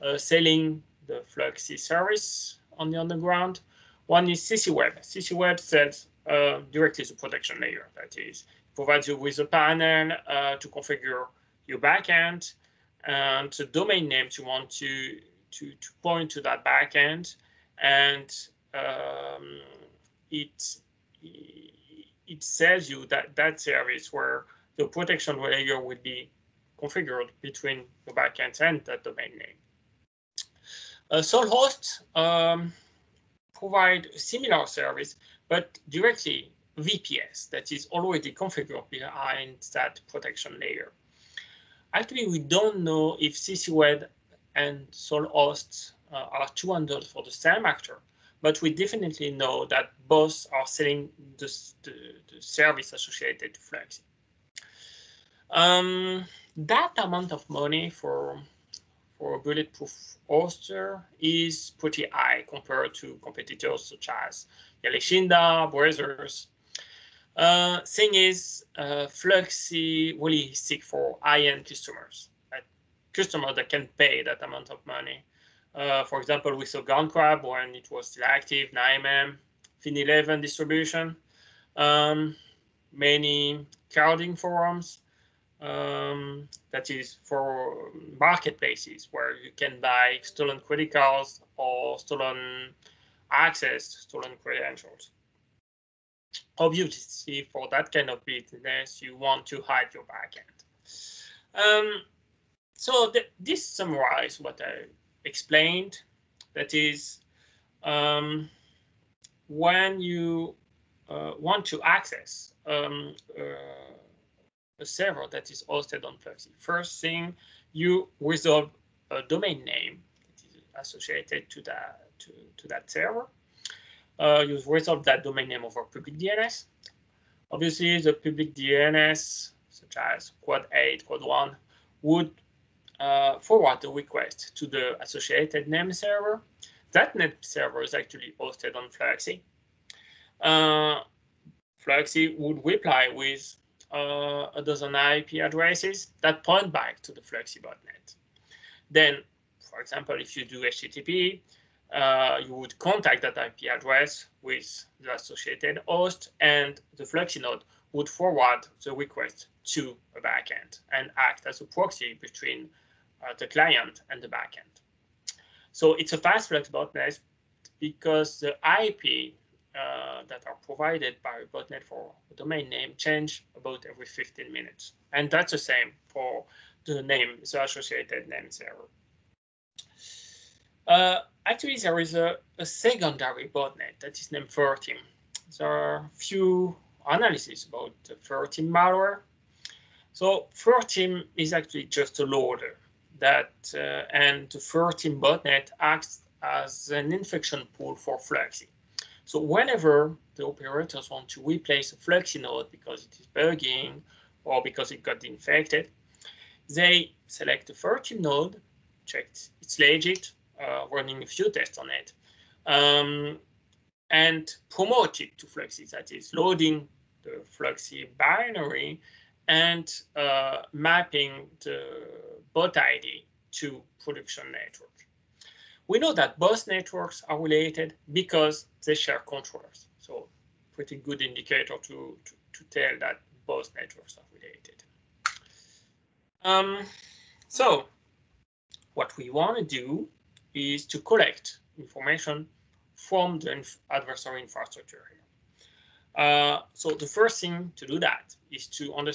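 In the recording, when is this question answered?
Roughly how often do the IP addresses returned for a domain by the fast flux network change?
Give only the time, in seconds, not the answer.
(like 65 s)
173 s.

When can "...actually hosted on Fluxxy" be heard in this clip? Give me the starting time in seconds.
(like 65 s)
137 s.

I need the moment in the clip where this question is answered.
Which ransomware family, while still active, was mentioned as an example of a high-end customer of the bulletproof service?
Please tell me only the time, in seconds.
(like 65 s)
76 s.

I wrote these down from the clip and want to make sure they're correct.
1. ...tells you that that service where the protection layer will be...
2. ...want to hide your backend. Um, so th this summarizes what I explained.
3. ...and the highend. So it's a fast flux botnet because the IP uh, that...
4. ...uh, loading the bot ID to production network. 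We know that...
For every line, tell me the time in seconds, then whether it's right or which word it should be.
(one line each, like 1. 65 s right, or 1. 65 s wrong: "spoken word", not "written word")
1. 22 s right
2. 99 s right
3. 164 s wrong: "backend", not "highend"
4. 220 s wrong: "mapping", not "loading".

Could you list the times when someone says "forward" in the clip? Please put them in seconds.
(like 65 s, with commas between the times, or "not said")
133 s, 158 s.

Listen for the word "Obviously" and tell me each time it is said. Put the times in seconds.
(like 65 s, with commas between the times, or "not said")
96 s, 127 s.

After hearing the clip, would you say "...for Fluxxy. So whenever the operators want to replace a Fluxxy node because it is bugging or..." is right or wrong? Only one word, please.
right.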